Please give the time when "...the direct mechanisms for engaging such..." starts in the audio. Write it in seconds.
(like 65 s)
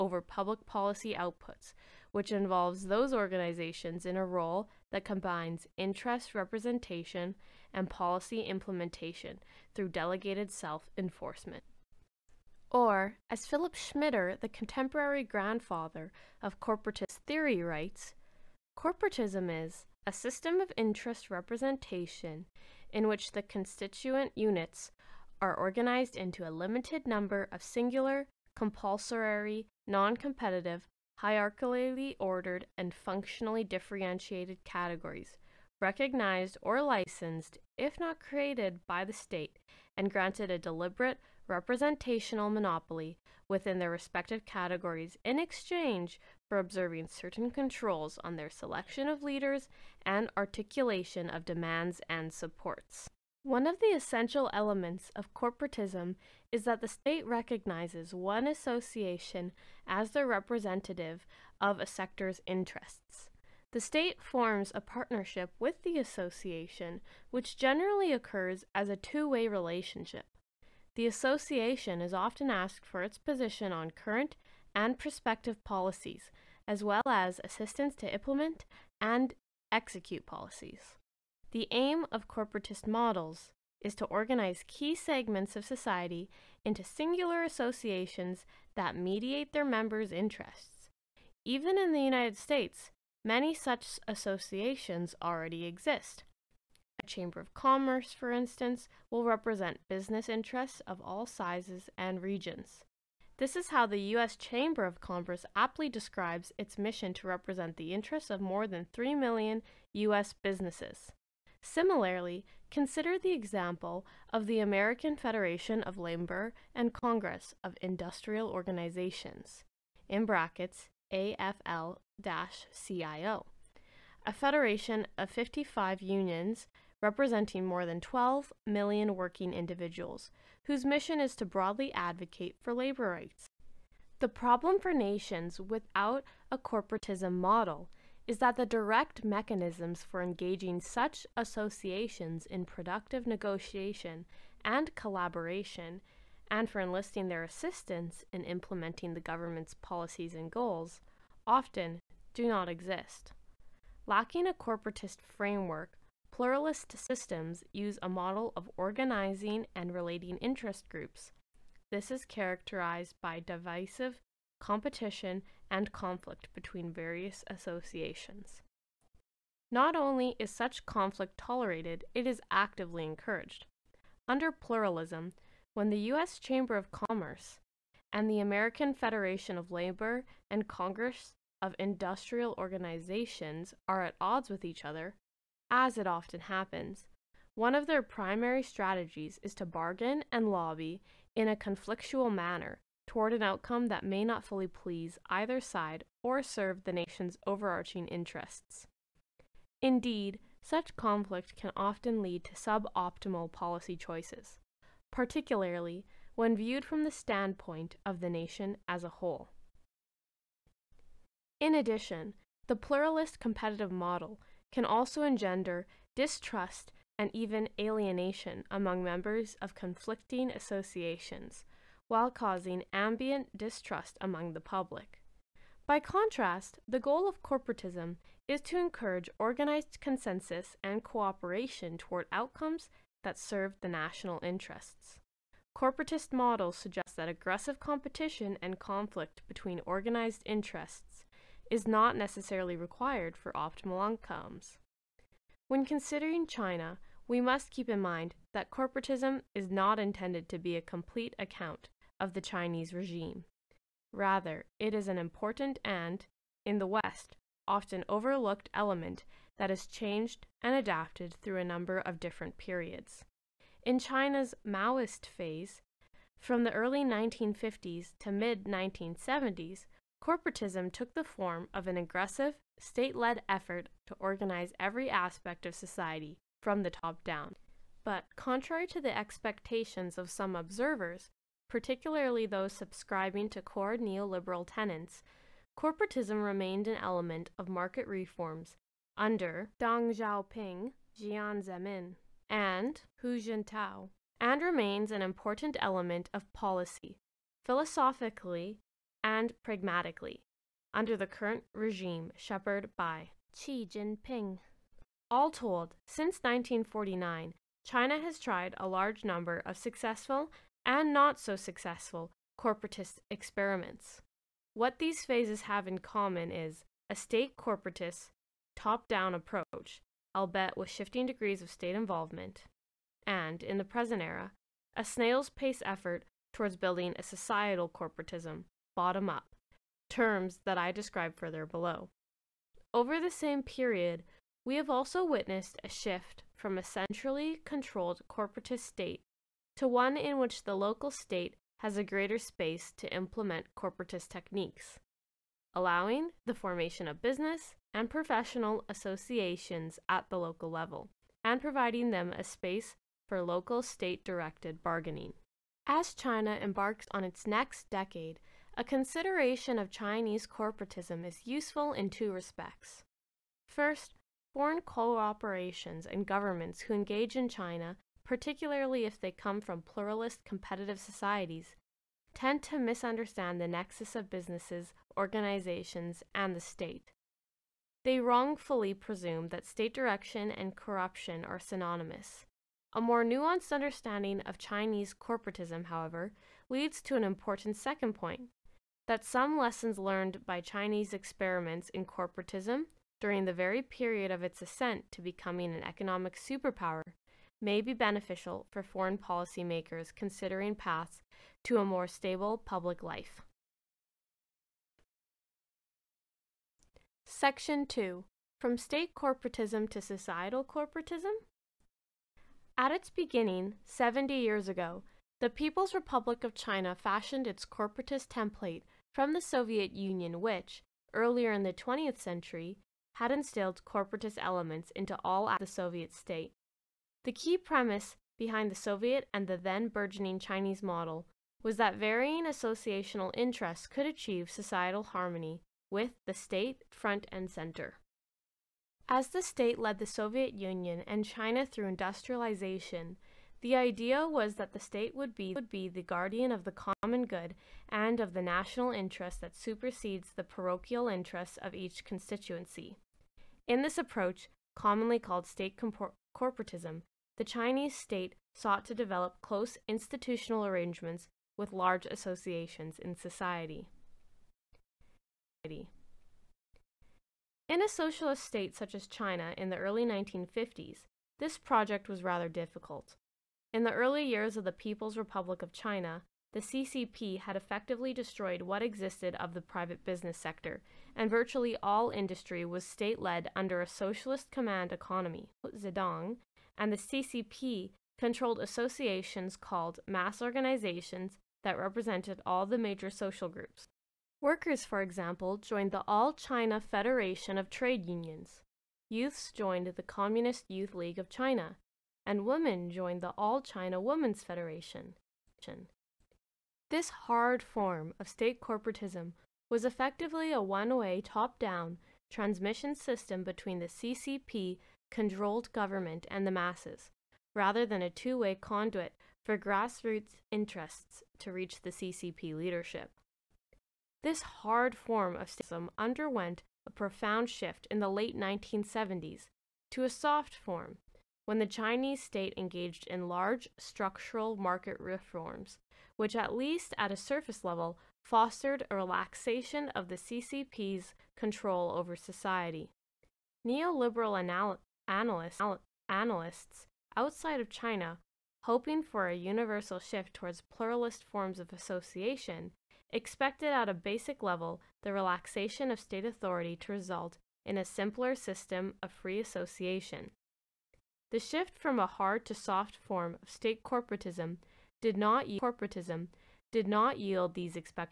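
138 s.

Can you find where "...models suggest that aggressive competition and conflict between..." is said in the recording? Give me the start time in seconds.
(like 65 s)
236 s.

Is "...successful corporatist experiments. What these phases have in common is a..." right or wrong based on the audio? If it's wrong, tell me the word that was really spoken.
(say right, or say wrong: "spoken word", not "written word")
right.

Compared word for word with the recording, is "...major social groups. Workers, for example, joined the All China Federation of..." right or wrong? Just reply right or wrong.
right.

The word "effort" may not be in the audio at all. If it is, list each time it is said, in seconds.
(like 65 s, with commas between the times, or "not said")
273 s, 325 s.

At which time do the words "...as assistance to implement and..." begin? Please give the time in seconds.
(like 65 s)
77 s.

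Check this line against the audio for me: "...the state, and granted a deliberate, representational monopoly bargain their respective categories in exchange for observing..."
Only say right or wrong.
wrong.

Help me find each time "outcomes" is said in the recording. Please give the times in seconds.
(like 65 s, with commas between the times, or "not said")
193 s, 232 s, 244 s.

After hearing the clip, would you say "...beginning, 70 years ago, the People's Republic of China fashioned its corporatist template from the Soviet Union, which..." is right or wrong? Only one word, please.
right.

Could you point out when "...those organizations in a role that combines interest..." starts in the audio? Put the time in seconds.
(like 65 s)
2 s.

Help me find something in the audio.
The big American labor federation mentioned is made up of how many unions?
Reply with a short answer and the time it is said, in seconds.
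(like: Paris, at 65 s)
55, at 125 s.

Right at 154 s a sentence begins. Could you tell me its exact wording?
Lacking a corporatist framework Pluralist systems use a model of organizing and relating interest groups.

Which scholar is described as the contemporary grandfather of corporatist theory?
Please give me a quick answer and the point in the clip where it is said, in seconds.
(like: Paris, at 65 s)
Philip Schmitter, at 13 s.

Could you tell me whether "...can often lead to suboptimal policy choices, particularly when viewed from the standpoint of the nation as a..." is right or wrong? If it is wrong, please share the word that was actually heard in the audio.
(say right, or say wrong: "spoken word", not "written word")
right.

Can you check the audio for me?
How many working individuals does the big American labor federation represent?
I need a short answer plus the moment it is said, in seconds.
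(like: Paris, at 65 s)
more than 12 million, at 127 s.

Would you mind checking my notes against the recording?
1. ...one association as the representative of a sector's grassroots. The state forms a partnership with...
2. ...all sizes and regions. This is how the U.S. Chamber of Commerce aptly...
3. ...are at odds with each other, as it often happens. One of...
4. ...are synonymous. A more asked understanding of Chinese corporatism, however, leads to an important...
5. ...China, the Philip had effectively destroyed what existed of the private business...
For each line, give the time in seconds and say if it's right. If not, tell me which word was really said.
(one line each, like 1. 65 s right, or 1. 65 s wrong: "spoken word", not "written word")
1. 58 s wrong: "interests", not "grassroots"
2. 101 s right
3. 183 s right
4. 381 s wrong: "nuanced", not "asked"
5. 475 s wrong: "CCP", not "Philip".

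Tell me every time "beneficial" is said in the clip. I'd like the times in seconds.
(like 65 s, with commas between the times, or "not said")
397 s.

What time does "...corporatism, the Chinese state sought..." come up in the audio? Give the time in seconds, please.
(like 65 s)
456 s.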